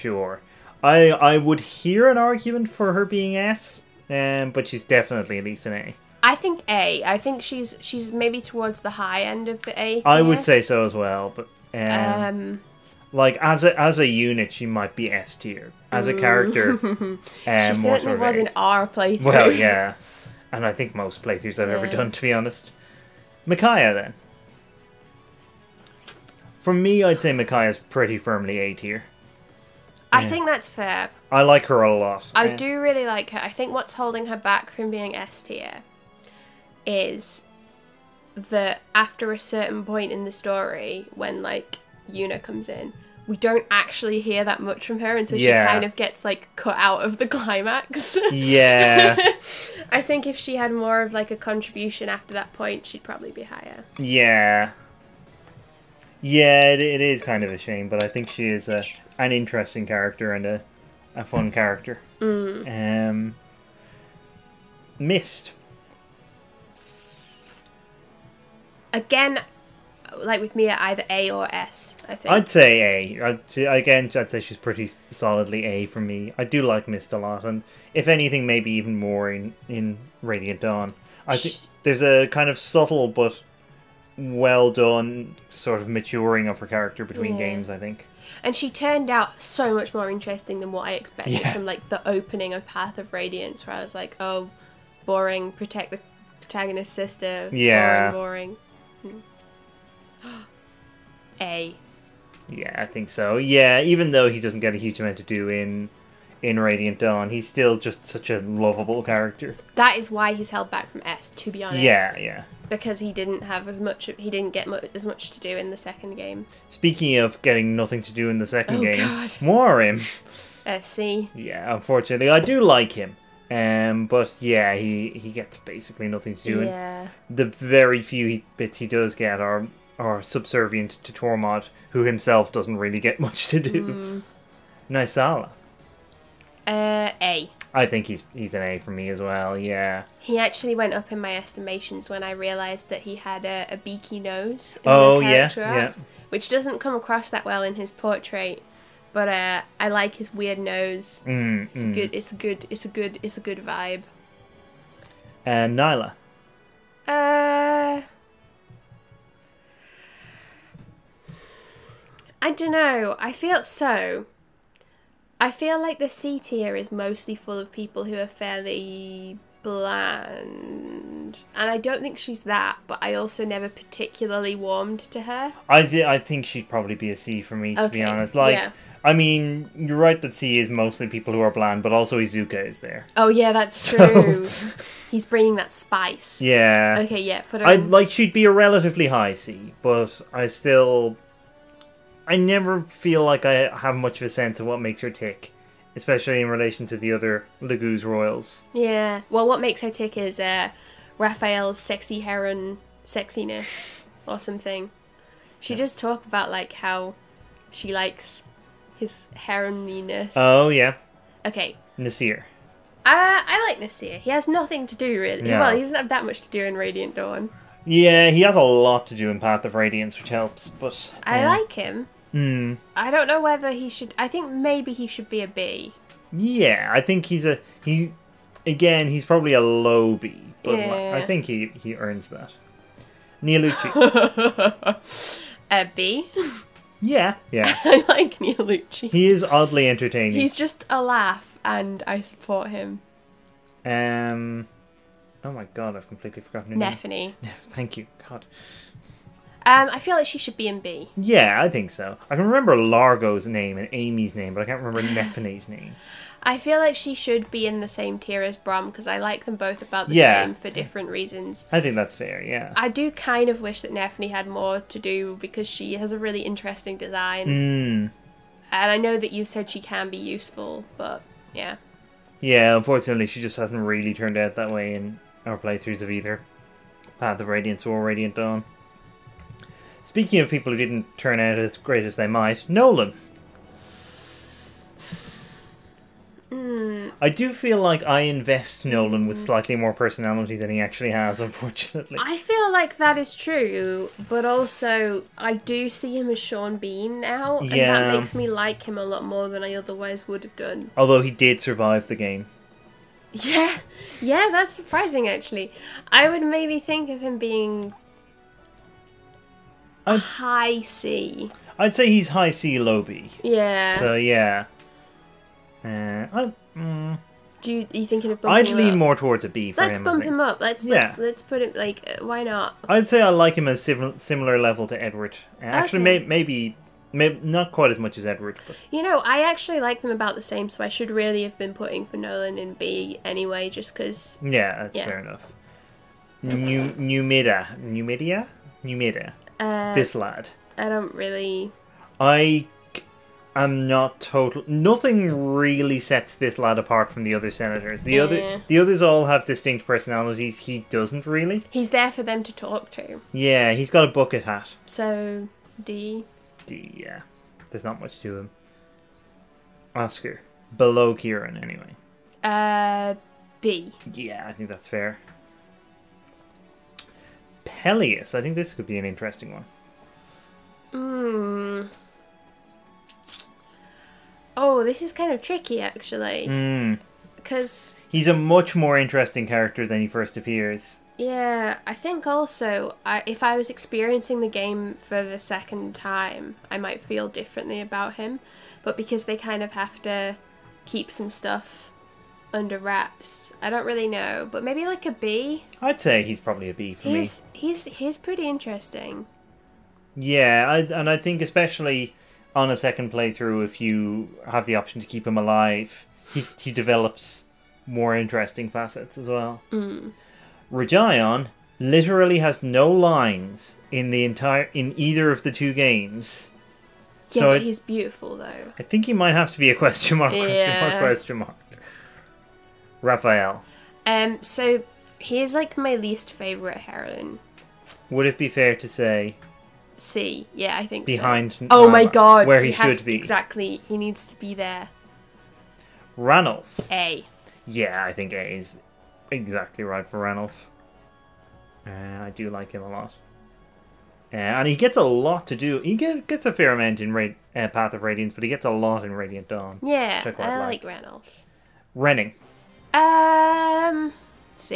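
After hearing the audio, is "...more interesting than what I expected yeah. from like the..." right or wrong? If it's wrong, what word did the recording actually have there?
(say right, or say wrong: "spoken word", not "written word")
right.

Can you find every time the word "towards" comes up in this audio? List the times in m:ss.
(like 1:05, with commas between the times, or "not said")
0:08, 5:19.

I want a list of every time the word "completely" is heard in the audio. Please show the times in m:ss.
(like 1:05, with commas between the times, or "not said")
4:06.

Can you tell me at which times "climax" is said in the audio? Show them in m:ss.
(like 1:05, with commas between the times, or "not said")
0:47.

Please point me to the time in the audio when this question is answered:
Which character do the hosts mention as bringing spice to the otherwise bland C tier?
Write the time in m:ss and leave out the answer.
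3:02.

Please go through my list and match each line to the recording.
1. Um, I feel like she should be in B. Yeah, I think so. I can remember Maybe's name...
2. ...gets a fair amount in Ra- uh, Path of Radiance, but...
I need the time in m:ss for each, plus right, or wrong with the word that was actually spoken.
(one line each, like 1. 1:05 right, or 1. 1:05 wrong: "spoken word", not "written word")
1. 4:09 wrong: "Largo", not "Maybe"
2. 7:26 right.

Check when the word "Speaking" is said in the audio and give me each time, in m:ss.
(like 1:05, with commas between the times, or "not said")
1:56, 4:40.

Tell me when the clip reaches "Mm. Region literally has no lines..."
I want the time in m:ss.
6:49.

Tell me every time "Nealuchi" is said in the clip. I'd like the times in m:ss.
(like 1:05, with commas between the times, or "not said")
3:53, 3:58.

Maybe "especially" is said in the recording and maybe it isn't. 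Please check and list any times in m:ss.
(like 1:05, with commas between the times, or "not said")
3:15, 6:41.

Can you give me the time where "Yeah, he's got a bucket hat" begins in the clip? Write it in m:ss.
5:53.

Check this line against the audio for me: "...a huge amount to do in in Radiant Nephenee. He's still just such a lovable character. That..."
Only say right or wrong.
wrong.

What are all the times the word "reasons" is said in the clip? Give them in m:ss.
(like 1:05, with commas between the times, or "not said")
4:21.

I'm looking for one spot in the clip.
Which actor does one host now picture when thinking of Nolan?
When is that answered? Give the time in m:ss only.
4:56.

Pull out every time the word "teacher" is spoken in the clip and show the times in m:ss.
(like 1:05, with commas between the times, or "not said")
not said.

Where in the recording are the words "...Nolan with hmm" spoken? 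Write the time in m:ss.
4:48.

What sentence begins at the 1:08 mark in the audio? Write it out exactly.
Again, like with Mia, either A or S.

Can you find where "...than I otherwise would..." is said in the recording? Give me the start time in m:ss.
4:59.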